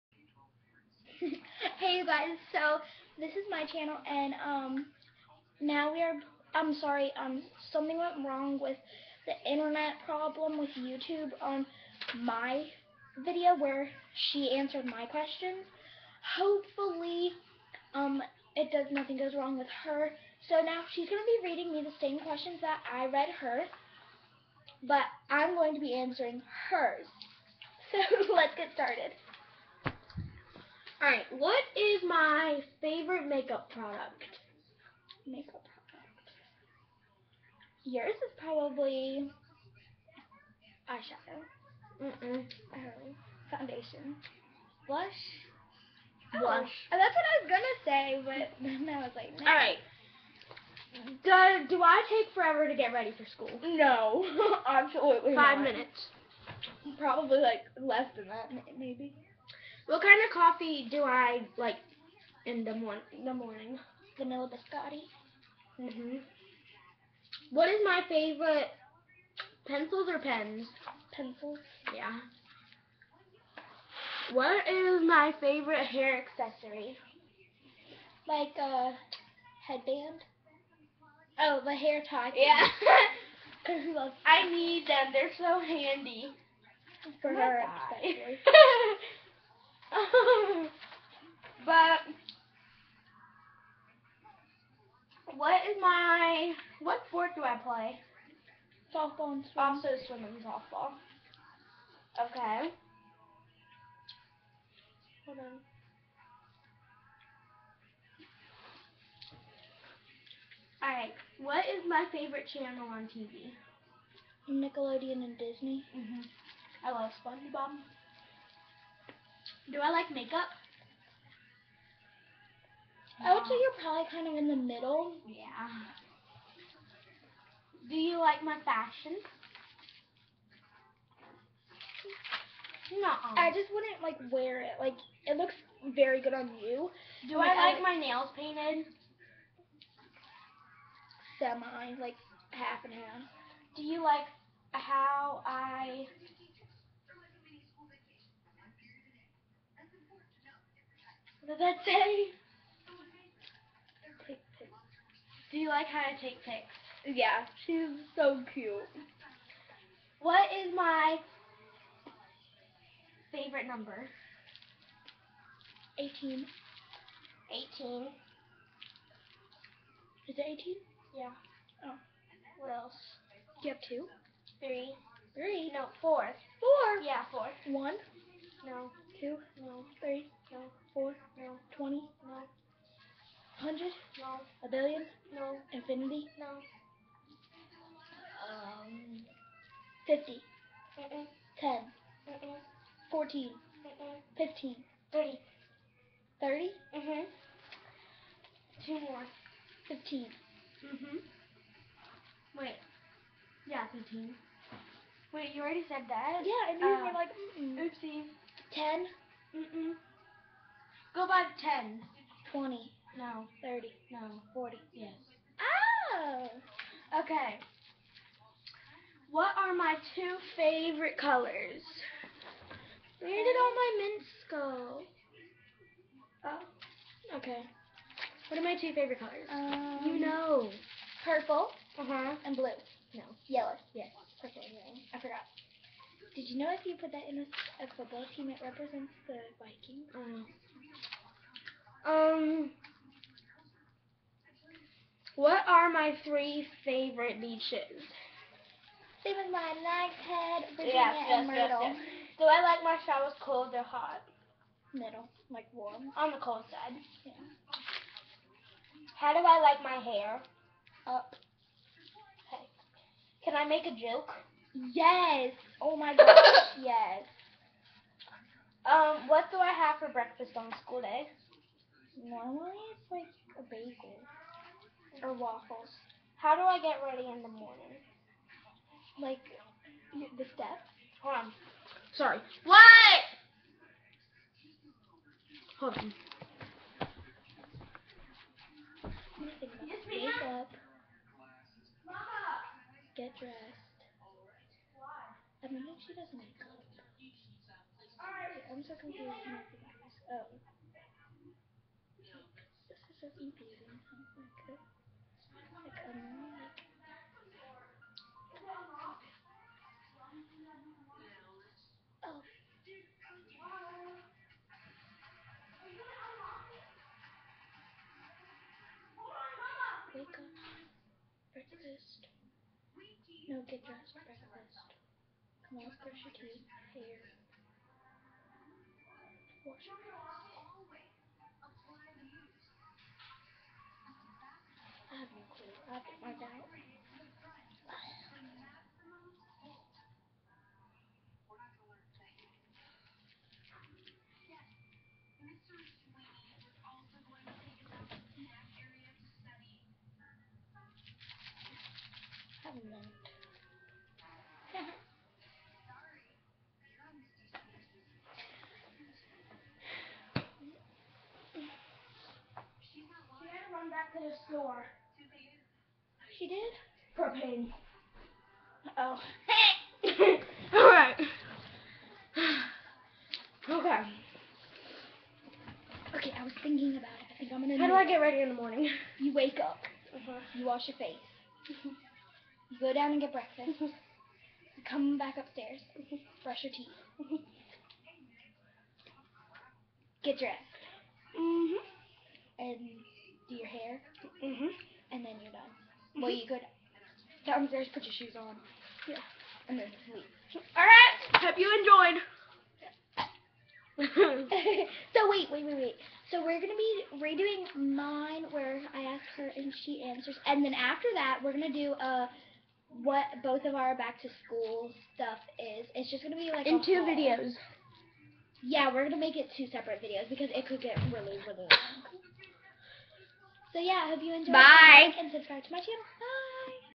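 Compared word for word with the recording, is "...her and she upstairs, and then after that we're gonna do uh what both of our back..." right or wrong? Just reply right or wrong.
wrong.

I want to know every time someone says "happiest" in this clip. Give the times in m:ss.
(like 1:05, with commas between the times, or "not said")
not said.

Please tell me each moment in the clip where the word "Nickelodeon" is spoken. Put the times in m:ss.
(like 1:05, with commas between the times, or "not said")
1:54.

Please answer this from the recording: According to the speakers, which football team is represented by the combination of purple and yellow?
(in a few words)
The Vikings.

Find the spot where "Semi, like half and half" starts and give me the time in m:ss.
2:21.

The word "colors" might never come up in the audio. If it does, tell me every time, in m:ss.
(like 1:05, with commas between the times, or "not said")
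3:41, 3:49.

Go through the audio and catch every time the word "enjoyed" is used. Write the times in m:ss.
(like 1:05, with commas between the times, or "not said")
6:41, 7:04.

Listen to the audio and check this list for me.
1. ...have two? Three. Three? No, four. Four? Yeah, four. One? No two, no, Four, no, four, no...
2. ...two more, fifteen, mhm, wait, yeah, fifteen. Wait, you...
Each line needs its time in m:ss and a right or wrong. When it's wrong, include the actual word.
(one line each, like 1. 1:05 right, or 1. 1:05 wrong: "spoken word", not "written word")
1. 2:53 wrong: "Three", not "Four"
2. 3:18 right.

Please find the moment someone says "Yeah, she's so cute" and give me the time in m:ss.
2:37.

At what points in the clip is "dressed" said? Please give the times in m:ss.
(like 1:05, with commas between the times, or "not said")
4:53, 5:23, 6:30.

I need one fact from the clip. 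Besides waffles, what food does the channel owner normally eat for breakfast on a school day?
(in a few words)
A bagel.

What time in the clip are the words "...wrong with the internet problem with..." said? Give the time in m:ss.
0:08.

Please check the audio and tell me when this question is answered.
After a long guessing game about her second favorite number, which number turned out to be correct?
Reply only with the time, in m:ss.
3:34.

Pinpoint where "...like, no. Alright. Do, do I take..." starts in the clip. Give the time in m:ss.
0:49.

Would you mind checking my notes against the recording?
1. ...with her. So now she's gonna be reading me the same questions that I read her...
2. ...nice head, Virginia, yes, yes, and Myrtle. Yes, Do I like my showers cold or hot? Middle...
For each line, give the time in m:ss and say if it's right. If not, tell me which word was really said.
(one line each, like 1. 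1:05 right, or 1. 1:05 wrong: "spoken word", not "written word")
1. 0:19 right
2. 4:09 right.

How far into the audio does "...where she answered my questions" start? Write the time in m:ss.
0:13.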